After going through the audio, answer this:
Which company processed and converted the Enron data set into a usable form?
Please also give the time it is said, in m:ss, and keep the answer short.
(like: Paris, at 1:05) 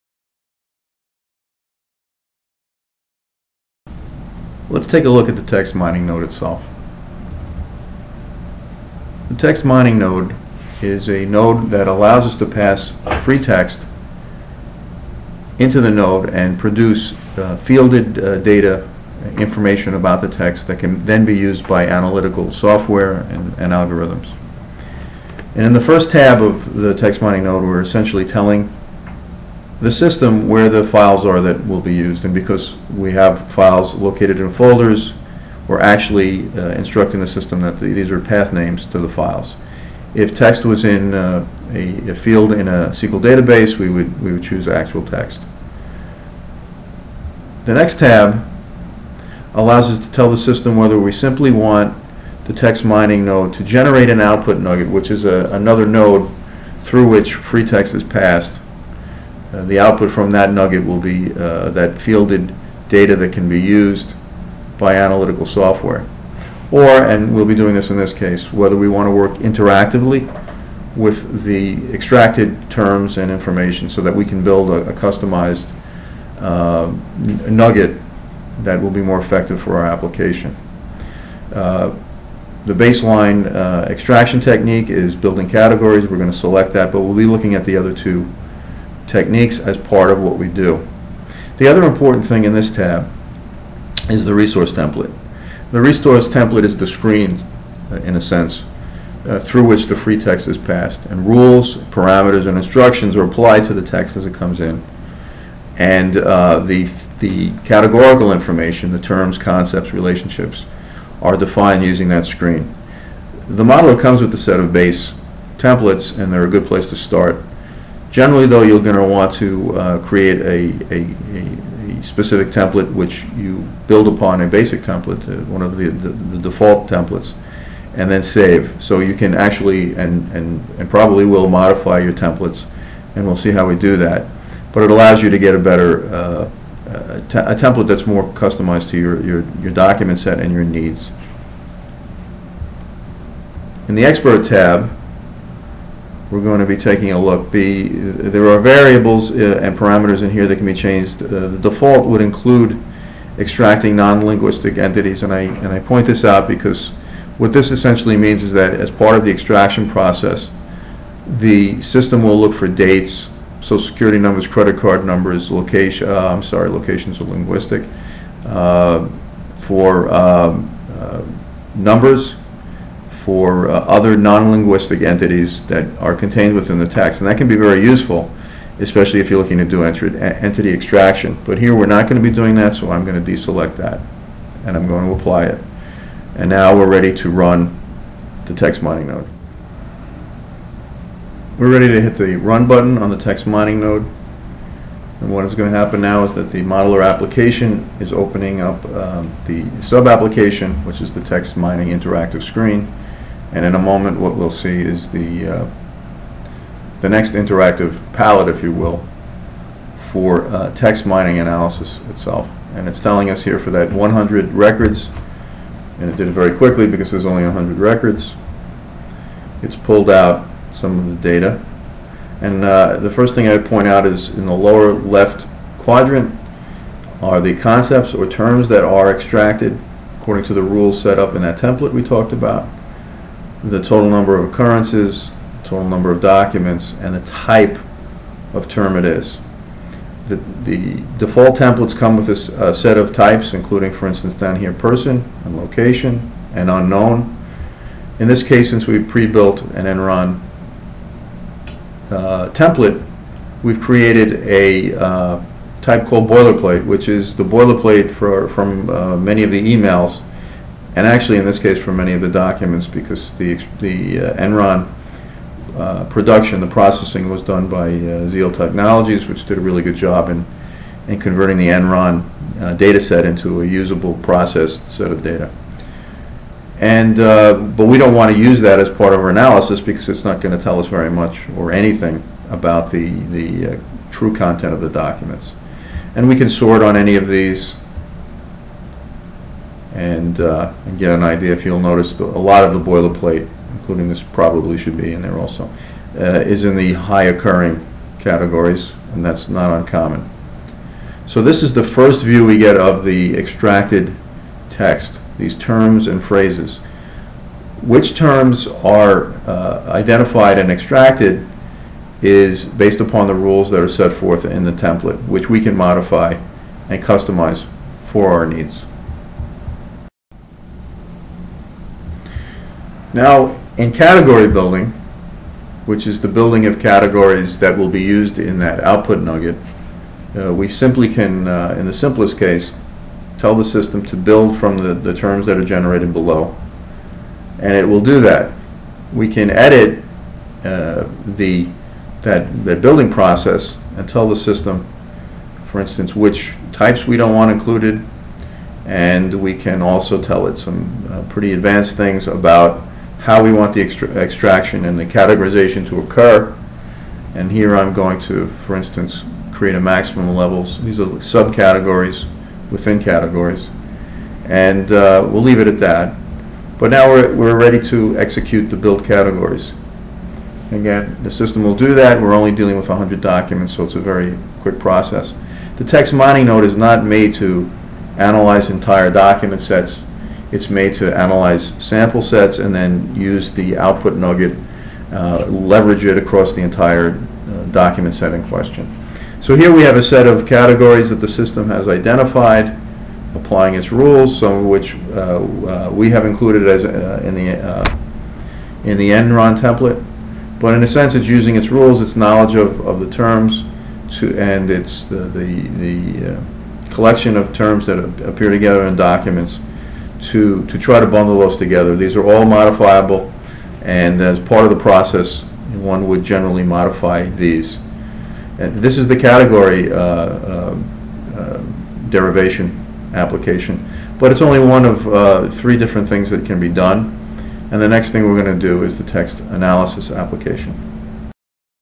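ZL Technologies, at 4:28.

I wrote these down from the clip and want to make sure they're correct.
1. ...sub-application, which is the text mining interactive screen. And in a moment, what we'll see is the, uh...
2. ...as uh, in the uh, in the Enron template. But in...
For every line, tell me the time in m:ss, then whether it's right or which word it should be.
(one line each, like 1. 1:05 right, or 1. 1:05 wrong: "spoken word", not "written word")
1. 3:19 right
2. 6:36 right.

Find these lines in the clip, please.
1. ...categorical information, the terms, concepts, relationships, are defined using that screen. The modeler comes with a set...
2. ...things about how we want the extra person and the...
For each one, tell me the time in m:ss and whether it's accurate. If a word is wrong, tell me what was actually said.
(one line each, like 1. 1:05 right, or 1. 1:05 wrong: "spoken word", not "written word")
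1. 1:47 right
2. 5:51 wrong: "extraction", not "person".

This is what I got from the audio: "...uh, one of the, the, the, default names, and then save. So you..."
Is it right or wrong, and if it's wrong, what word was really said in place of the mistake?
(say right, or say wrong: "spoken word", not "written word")
wrong: "templates", not "names".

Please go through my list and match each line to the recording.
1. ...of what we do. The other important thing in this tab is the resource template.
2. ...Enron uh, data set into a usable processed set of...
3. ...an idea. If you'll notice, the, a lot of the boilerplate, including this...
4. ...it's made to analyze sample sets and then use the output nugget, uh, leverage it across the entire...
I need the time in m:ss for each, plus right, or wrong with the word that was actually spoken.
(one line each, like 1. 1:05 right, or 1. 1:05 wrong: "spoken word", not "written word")
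1. 1:30 right
2. 4:31 right
3. 4:51 right
4. 6:20 right.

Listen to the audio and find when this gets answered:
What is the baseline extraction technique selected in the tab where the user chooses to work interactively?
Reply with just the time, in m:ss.
1:25.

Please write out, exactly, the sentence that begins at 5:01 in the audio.
So this is the first view we get of the extracted text, these terms and phrases.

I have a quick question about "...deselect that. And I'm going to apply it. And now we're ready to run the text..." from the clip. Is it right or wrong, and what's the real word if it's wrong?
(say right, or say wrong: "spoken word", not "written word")
right.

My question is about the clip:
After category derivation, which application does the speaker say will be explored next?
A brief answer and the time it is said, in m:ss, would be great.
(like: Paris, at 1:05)
Text analysis application, at 7:09.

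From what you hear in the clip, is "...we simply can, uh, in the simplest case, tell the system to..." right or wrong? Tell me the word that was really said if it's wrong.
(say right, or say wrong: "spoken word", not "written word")
right.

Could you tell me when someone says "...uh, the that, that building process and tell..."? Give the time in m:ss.
5:40.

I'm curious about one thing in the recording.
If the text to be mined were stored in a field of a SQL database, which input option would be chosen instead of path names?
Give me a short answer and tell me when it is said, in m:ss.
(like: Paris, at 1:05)
Actual text, at 0:44.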